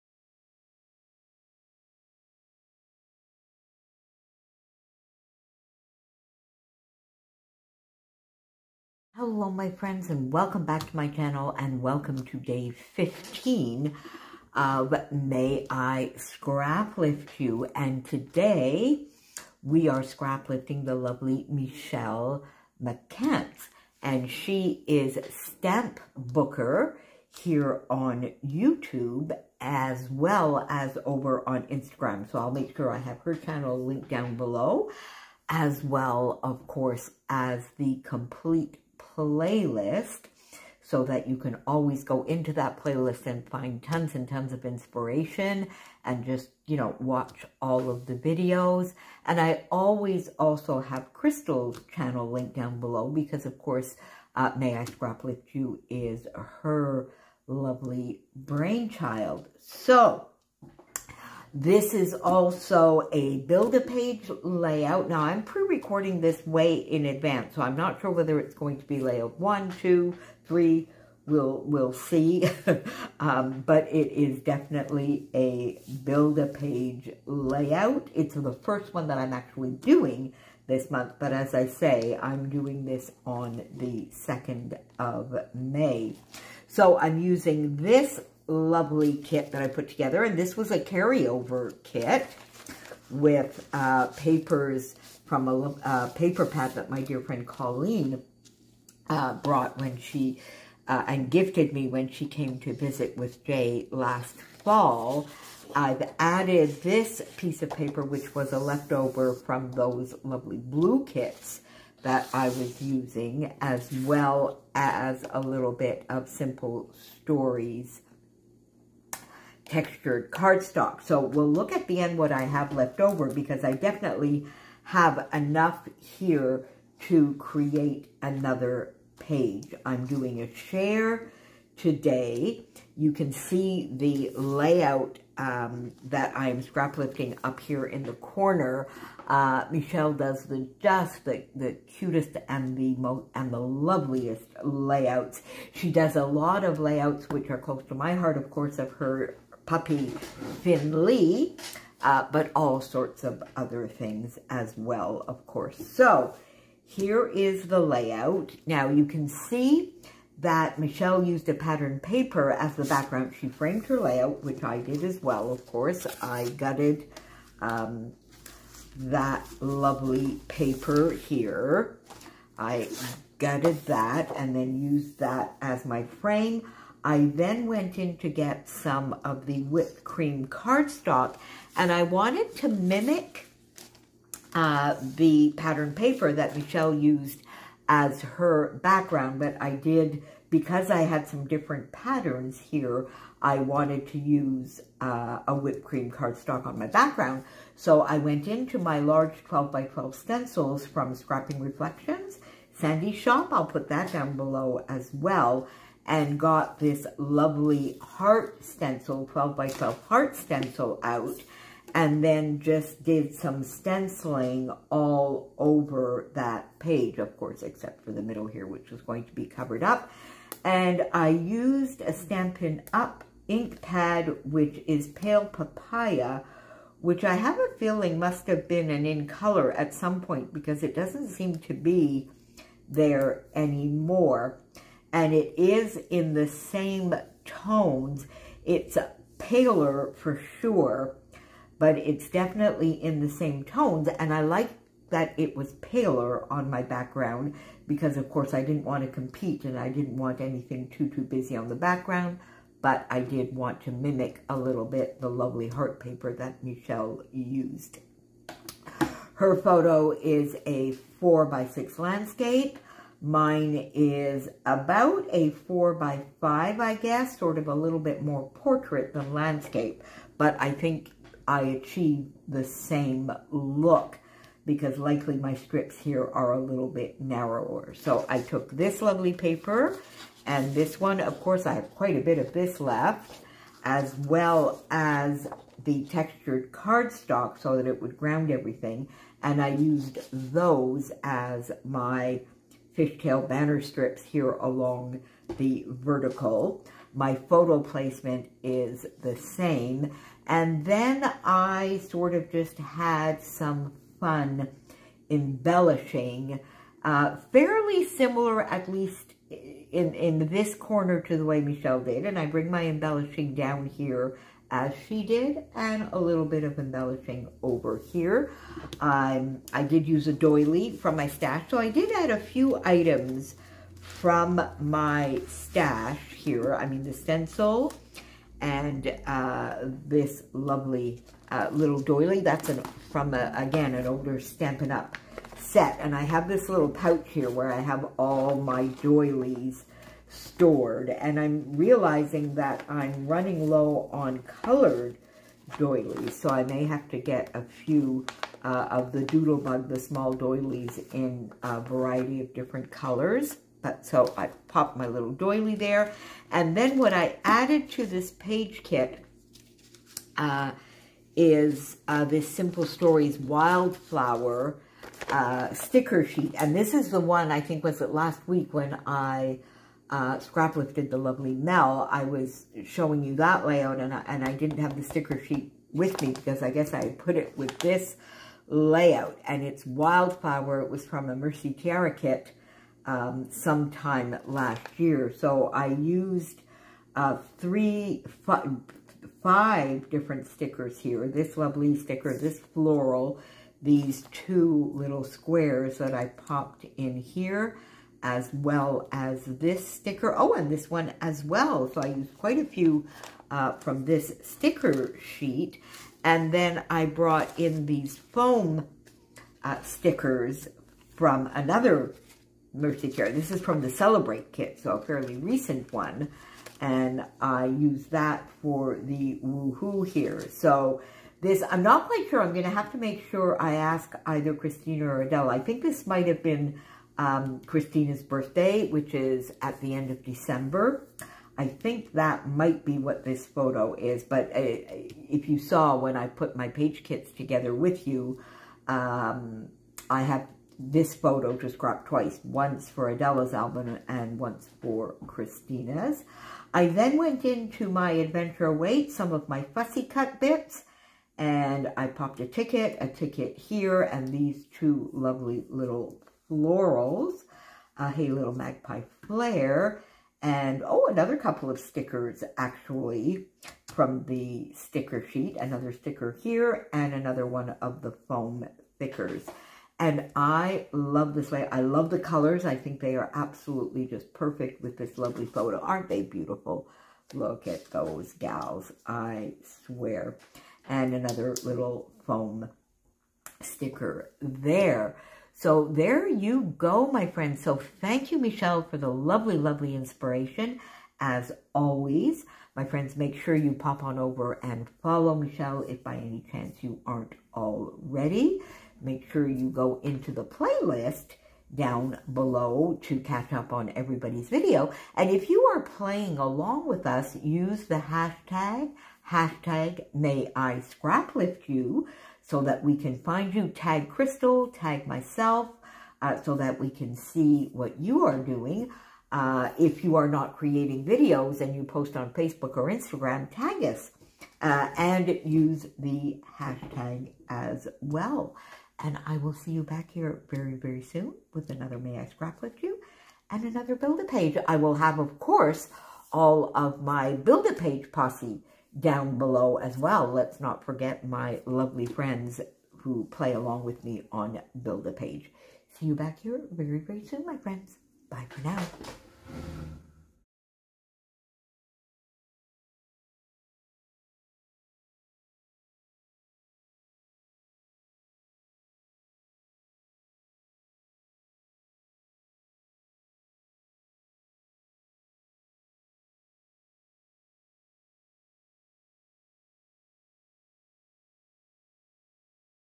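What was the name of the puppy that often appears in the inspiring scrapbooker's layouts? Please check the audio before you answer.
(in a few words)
Finley.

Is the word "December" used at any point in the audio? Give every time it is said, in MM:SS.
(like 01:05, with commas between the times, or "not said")
07:10.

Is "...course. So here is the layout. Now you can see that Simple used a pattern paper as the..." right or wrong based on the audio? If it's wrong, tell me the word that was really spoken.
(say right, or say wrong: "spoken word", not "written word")
wrong: "Michele", not "Simple".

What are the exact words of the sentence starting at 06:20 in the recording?
It was from a Mercy Tiara kit um, sometime last year.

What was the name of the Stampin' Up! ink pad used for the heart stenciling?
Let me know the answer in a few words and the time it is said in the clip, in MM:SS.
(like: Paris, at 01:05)
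Pale Papaya, at 03:45.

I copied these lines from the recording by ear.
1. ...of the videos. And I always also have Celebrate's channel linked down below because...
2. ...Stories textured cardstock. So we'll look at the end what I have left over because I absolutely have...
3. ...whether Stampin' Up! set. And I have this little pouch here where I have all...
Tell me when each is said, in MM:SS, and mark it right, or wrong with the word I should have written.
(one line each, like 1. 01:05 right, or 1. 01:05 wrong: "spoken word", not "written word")
1. 00:47 wrong: "Crystal", not "Celebrate"
2. 01:57 wrong: "definitely", not "absolutely"
3. 05:34 wrong: "older", not "whether".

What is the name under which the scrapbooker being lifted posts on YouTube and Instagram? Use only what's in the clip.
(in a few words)
Stamp Booker.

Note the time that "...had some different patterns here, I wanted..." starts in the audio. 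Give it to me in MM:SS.
03:11.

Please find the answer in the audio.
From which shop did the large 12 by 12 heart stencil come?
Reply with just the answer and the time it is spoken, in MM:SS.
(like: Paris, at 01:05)
Scrapping Reflections, at 03:21.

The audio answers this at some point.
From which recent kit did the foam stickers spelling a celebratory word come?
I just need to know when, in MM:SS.
06:53.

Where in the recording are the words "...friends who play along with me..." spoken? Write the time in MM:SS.
09:02.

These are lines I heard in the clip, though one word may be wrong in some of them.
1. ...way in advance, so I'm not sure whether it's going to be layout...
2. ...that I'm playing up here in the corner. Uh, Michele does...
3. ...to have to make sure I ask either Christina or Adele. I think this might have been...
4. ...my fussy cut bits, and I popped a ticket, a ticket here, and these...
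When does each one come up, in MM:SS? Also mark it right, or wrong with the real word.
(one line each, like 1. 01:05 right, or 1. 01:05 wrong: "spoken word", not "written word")
1. 01:06 right
2. 02:16 wrong: "scraplifting", not "playing"
3. 07:02 right
4. 07:29 right.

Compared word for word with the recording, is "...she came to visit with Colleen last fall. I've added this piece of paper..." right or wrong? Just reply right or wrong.
wrong.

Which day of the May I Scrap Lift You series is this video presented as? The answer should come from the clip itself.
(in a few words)
15.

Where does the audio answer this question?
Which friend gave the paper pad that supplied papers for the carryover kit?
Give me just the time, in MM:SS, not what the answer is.
01:37.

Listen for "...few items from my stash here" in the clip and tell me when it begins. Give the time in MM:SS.
05:22.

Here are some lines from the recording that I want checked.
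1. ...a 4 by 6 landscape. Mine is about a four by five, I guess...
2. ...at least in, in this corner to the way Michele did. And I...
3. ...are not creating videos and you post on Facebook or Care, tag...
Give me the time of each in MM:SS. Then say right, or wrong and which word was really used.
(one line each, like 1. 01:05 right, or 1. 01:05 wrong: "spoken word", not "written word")
1. 04:20 right
2. 05:08 right
3. 08:40 wrong: "Instagram", not "Care".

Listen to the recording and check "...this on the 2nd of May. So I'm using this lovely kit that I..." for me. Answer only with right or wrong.
right.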